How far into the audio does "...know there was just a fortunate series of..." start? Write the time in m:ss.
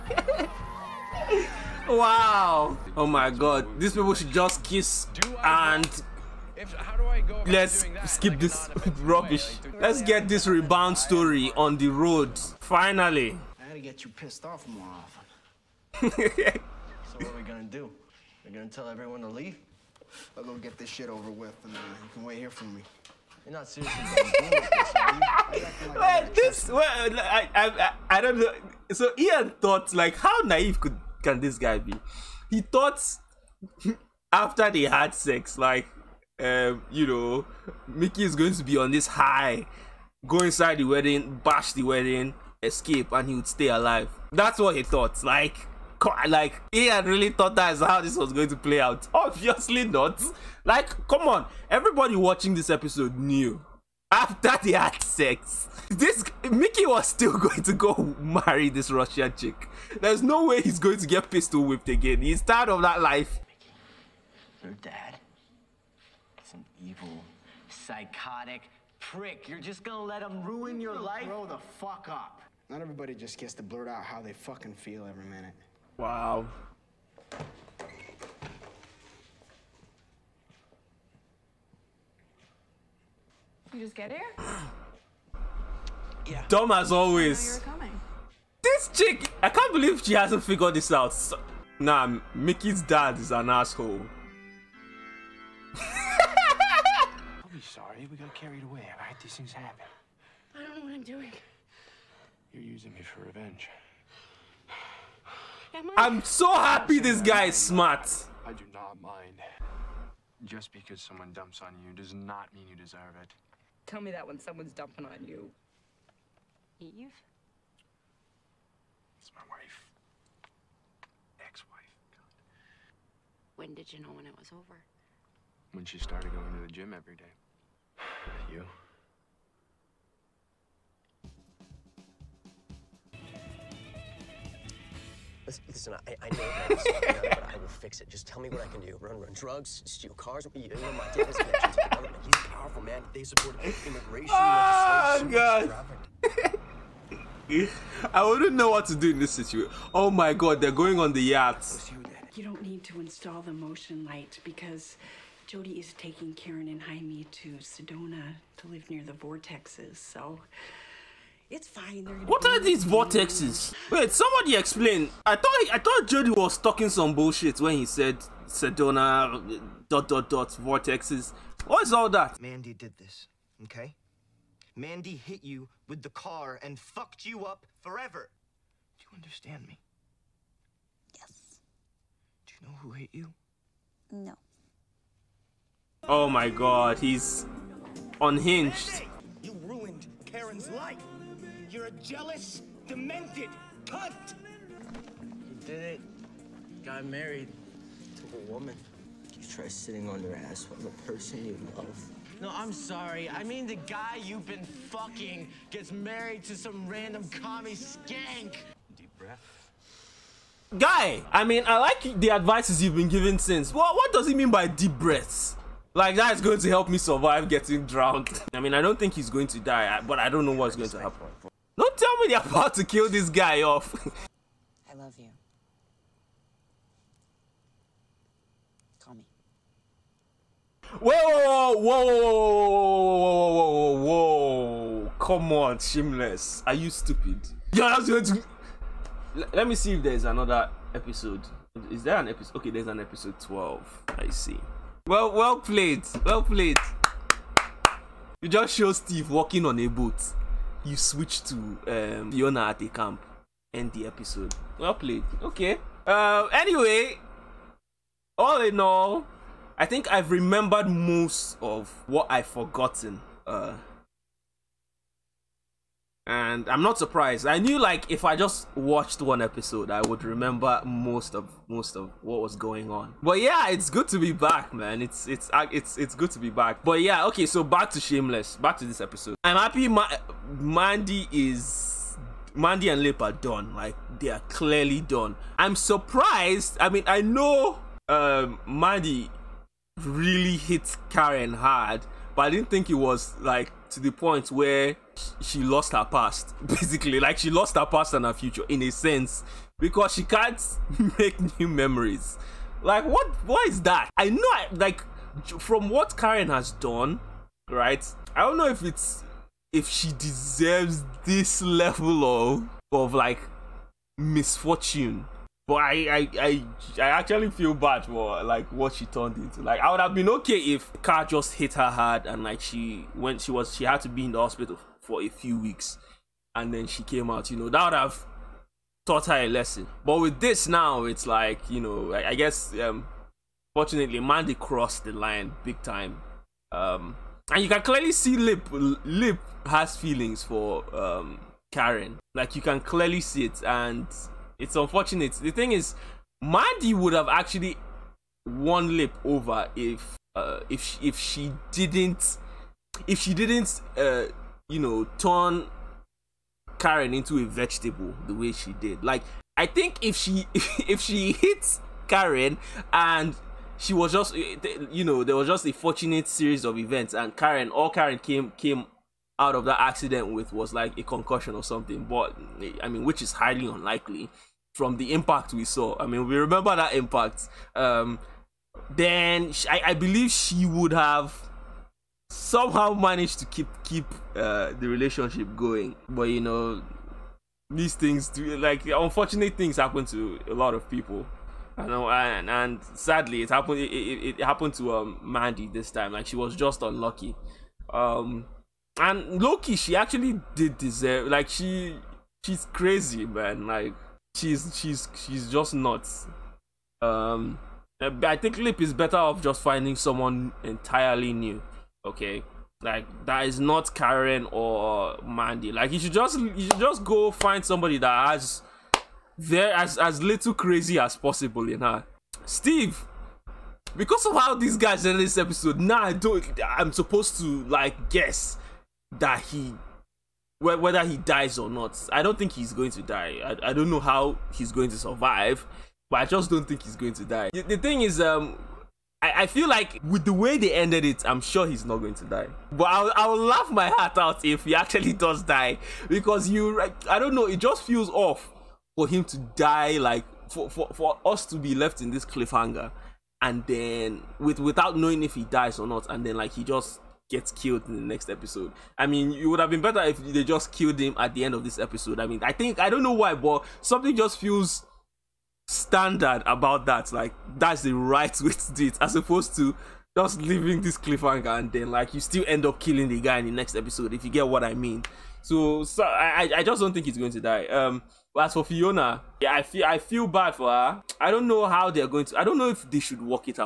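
6:05.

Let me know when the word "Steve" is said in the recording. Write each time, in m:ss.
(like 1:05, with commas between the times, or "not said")
4:08, 7:02.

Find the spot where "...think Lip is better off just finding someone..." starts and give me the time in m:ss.
6:48.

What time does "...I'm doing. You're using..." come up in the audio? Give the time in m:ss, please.
1:40.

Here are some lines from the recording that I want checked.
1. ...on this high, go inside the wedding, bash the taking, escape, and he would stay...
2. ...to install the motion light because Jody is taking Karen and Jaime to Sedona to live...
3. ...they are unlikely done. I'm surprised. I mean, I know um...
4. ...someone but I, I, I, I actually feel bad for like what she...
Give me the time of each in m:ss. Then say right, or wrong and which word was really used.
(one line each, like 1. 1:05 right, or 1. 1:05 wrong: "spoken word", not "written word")
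1. 0:38 wrong: "wedding", not "taking"
2. 2:32 right
3. 4:44 wrong: "clearly", not "unlikely"
4. 5:14 wrong: "misfortune", not "someone".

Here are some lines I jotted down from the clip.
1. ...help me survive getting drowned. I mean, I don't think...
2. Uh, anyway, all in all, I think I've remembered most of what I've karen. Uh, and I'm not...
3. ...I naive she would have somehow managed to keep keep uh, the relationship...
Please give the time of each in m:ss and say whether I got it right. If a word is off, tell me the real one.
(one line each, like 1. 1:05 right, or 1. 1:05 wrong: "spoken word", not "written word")
1. 3:36 right
2. 4:16 wrong: "forgotten", not "karen"
3. 6:19 wrong: "believe", not "naive".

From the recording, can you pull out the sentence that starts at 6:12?
But eh, I mean, which is highly unlikely from the impact we saw.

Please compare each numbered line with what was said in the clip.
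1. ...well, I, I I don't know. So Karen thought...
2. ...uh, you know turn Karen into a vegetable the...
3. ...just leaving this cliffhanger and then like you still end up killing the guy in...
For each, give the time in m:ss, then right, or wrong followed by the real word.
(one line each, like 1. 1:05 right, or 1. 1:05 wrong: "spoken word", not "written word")
1. 0:26 wrong: "Ian", not "Karen"
2. 5:53 right
3. 7:50 right.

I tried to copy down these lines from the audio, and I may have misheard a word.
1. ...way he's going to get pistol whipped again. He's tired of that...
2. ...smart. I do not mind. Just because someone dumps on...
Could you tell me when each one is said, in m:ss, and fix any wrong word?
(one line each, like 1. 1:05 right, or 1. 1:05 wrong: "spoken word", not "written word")
1. 1:00 right
2. 1:47 right.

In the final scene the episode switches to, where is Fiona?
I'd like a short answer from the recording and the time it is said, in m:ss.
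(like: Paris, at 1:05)
the camp, at 4:12.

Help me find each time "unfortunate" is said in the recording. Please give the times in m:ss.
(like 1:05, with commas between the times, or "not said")
5:44, 6:28.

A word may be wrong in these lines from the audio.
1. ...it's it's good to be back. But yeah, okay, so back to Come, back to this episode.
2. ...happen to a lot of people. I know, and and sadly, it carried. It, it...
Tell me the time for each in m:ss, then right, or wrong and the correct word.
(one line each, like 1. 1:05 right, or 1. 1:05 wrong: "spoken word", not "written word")
1. 4:35 wrong: "Shameless", not "Come"
2. 6:29 wrong: "happened", not "carried".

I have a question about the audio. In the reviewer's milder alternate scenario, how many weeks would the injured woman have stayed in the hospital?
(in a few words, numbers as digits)
a few weeks.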